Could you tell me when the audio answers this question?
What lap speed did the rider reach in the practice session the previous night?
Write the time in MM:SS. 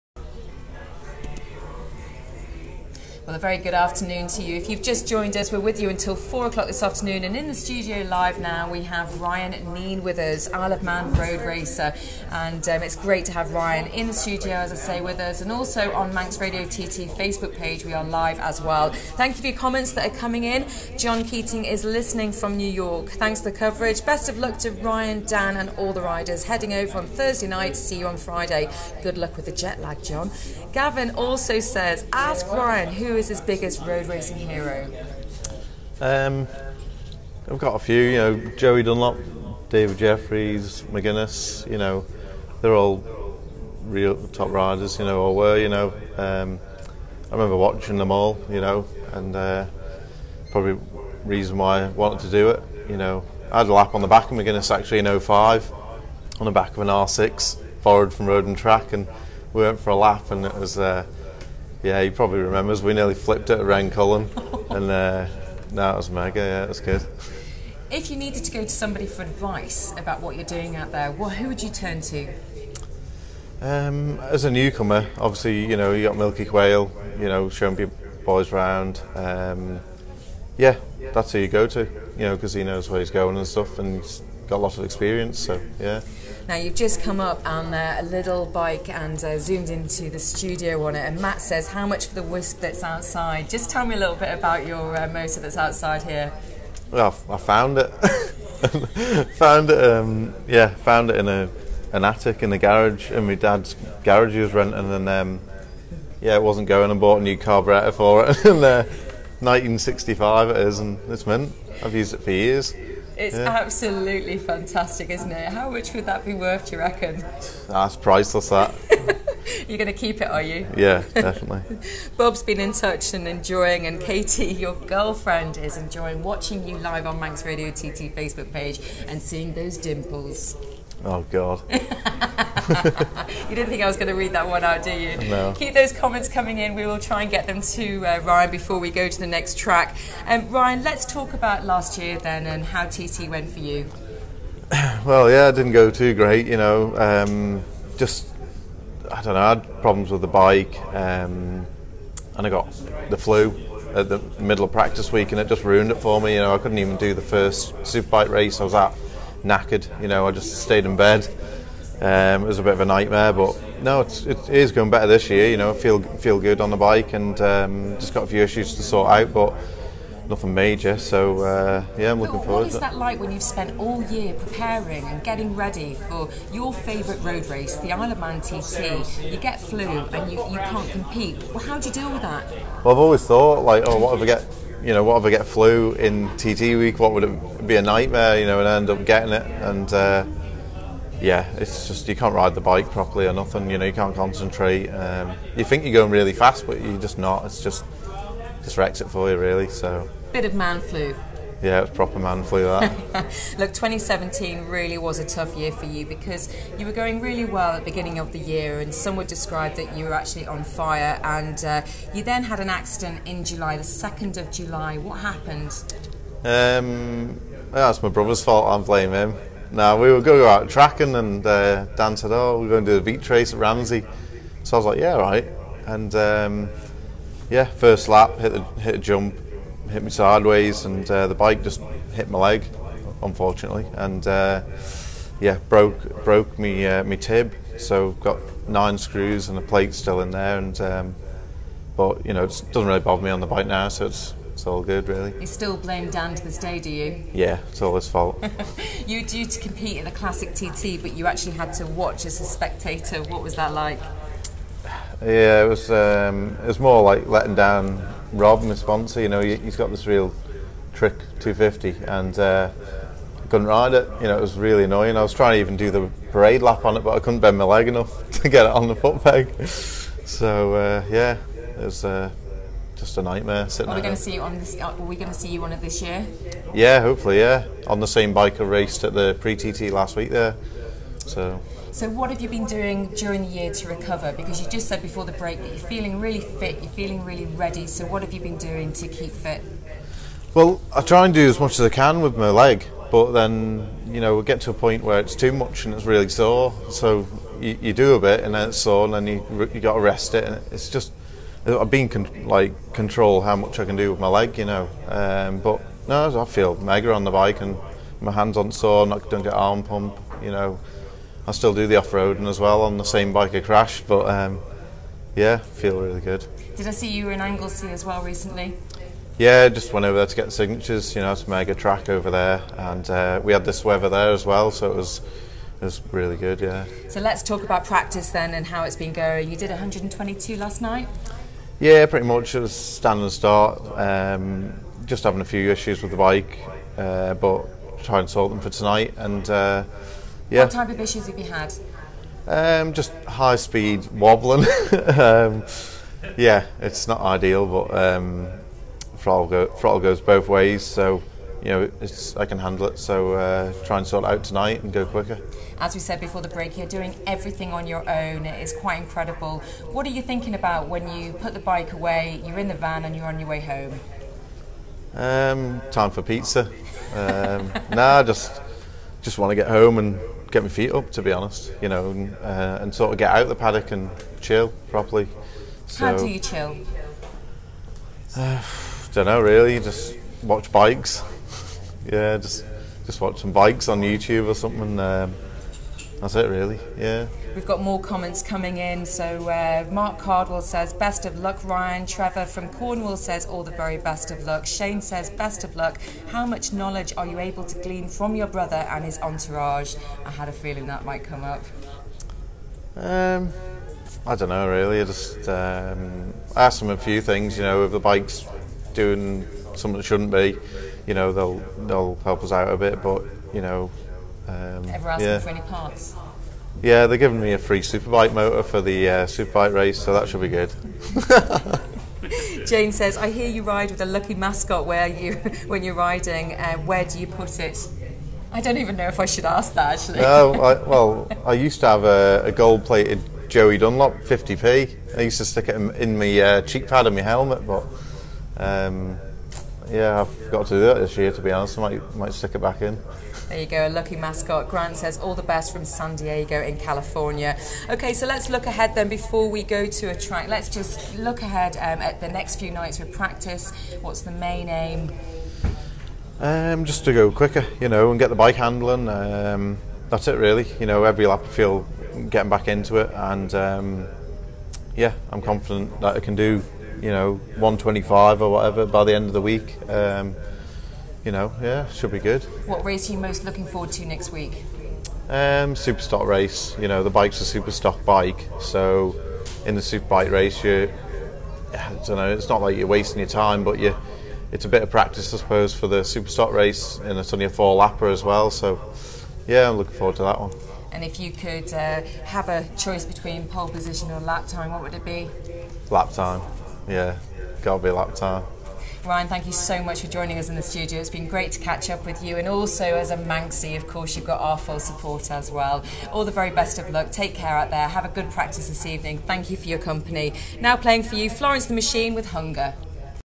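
05:29.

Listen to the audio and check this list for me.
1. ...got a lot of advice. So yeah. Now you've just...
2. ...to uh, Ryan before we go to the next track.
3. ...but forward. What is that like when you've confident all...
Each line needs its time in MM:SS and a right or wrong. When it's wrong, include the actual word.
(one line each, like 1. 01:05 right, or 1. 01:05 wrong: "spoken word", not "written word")
1. 01:24 wrong: "experience", not "advice"
2. 02:17 right
3. 02:52 wrong: "spent", not "confident".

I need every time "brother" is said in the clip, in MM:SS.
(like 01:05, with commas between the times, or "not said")
03:38, 06:38.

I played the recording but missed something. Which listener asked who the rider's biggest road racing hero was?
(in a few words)
Gavin.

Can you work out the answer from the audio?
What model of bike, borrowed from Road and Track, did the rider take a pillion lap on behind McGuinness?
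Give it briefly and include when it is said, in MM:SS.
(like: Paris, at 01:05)
R6, at 00:56.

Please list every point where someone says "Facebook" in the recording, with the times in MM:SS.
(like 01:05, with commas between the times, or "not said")
00:17, 02:08.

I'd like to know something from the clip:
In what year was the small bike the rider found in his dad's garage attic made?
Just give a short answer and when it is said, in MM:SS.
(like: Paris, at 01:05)
1965, at 01:49.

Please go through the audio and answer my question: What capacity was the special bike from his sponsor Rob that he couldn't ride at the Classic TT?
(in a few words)
250.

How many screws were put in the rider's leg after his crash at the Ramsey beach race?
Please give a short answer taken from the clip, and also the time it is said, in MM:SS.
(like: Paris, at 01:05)
9, at 03:58.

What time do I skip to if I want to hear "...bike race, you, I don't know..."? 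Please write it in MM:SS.
08:00.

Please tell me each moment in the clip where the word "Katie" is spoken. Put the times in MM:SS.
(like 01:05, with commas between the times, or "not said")
02:04.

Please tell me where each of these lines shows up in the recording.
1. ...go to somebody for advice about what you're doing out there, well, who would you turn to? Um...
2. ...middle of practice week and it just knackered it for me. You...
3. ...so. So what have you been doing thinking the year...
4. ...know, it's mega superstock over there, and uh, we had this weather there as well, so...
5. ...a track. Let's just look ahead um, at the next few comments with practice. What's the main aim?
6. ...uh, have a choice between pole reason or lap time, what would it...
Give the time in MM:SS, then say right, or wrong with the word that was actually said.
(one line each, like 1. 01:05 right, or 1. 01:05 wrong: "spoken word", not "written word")
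1. 01:08 right
2. 02:34 wrong: "ruined", not "knackered"
3. 04:41 wrong: "during", not "thinking"
4. 05:21 wrong: "track", not "superstock"
5. 07:30 wrong: "nights", not "comments"
6. 08:11 wrong: "position", not "reason".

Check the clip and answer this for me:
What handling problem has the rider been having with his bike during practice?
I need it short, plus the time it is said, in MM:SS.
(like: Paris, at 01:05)
High speed wobbling, at 05:43.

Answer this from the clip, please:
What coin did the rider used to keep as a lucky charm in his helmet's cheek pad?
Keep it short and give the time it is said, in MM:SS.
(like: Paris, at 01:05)
Gold-plated Joey Dunlop 50p, at 07:12.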